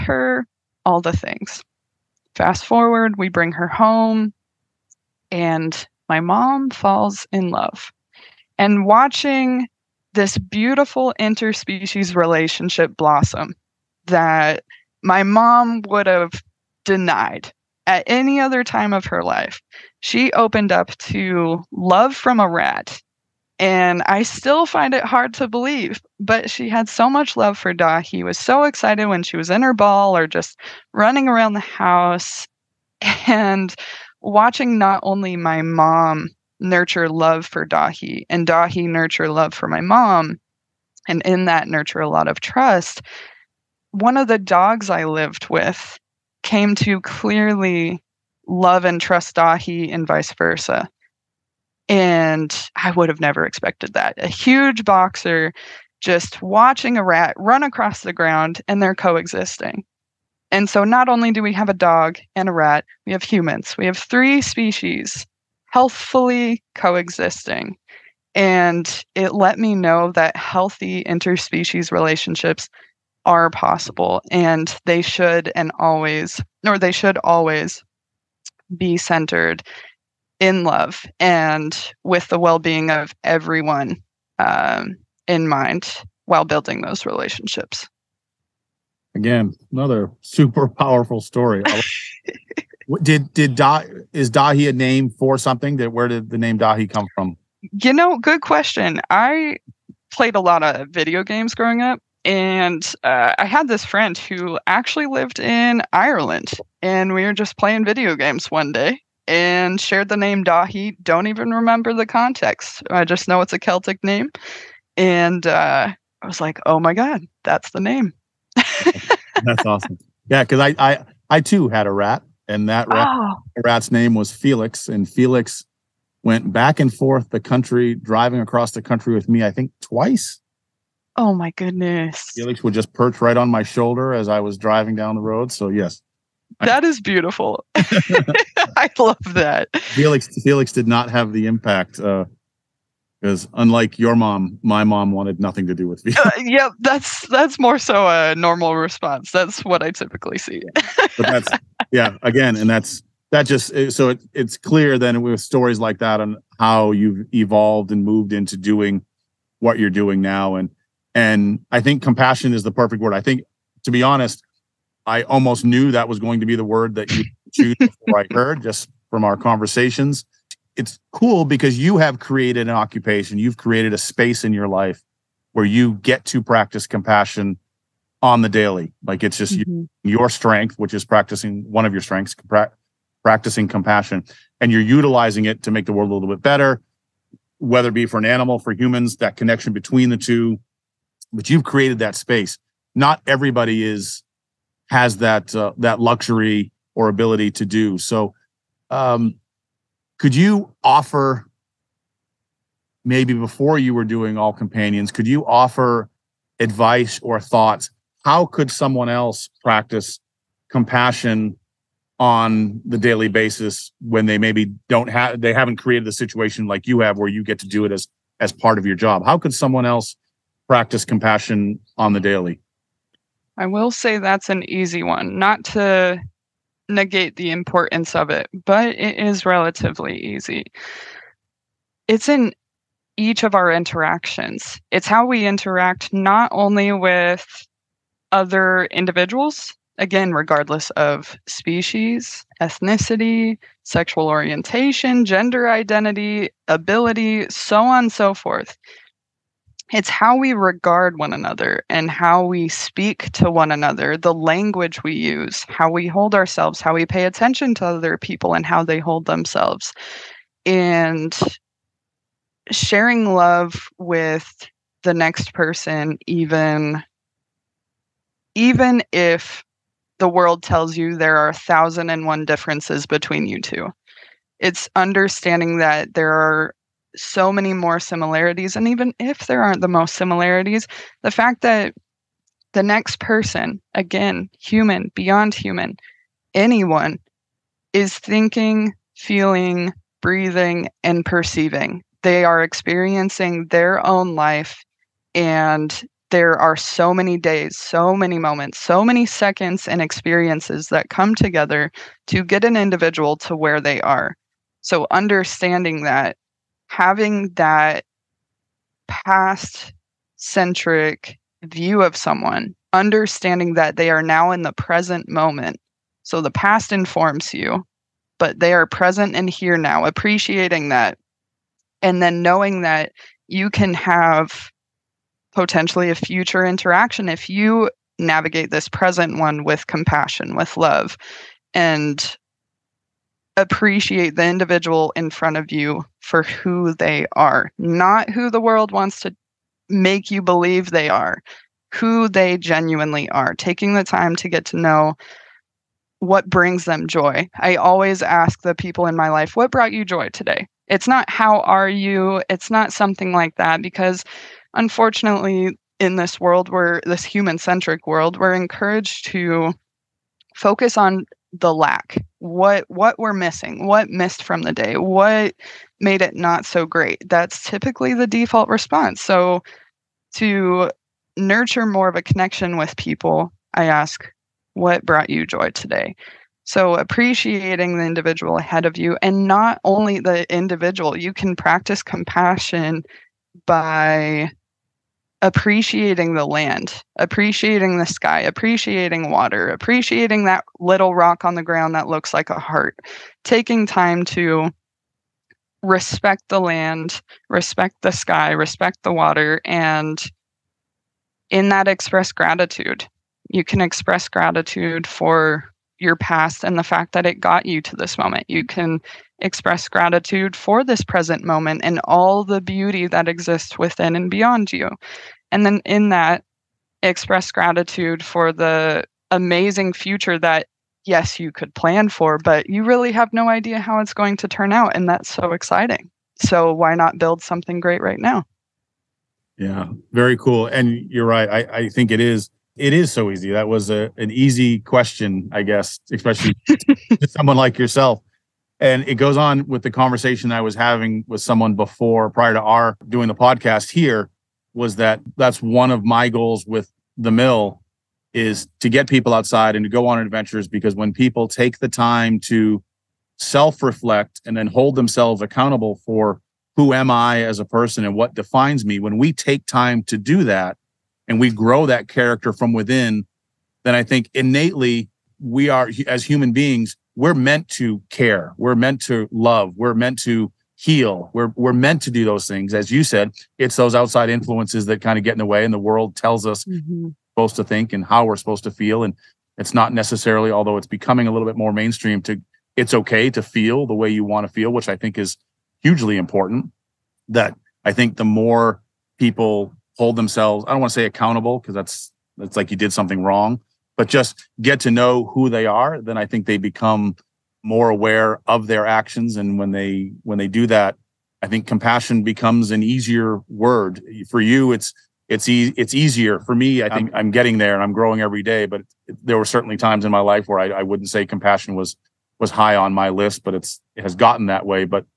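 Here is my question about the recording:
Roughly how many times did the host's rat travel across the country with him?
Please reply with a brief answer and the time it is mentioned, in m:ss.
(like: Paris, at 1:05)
Twice, at 2:09.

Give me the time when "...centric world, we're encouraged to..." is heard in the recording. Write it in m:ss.
5:57.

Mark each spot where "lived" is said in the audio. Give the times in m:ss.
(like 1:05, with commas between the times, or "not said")
0:45, 1:45.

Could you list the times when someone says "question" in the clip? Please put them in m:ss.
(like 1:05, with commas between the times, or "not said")
1:38, 7:14.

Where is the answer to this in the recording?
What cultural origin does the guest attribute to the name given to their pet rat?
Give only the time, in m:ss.
1:53.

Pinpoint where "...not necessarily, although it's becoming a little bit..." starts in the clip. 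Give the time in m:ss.
7:59.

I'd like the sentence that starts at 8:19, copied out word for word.
And when they when they do that, I think compassion becomes an easier word.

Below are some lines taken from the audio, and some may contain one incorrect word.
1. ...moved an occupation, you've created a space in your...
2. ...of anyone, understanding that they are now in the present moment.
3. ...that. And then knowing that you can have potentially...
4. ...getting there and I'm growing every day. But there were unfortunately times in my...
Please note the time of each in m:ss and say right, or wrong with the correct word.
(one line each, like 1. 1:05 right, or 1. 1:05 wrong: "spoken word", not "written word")
1. 2:52 wrong: "created", not "moved"
2. 5:12 wrong: "someone", not "anyone"
3. 5:20 right
4. 8:27 wrong: "certainly", not "unfortunately".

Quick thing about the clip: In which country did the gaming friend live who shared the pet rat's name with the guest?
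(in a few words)
Ireland.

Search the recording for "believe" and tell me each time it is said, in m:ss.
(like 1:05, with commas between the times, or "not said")
0:25, 5:40.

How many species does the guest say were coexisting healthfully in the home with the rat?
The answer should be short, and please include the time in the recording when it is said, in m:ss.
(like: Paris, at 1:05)
3, at 1:03.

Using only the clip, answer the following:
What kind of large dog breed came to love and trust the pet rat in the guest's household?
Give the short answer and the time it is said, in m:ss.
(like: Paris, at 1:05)
Boxer, at 0:54.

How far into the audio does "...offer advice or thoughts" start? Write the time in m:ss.
3:25.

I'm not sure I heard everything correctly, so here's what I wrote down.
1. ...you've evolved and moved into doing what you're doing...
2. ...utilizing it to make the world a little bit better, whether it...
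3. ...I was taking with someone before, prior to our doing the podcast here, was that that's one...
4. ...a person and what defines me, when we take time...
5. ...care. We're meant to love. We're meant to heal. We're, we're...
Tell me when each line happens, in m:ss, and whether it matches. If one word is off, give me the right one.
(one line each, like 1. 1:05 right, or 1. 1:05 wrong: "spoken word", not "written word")
1. 2:36 right
2. 3:04 right
3. 7:20 wrong: "having", not "taking"
4. 7:37 right
5. 7:48 right.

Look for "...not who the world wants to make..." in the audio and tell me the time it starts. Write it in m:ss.
5:37.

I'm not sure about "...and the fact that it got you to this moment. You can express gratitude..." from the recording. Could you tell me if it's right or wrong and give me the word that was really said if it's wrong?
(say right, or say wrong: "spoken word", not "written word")
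right.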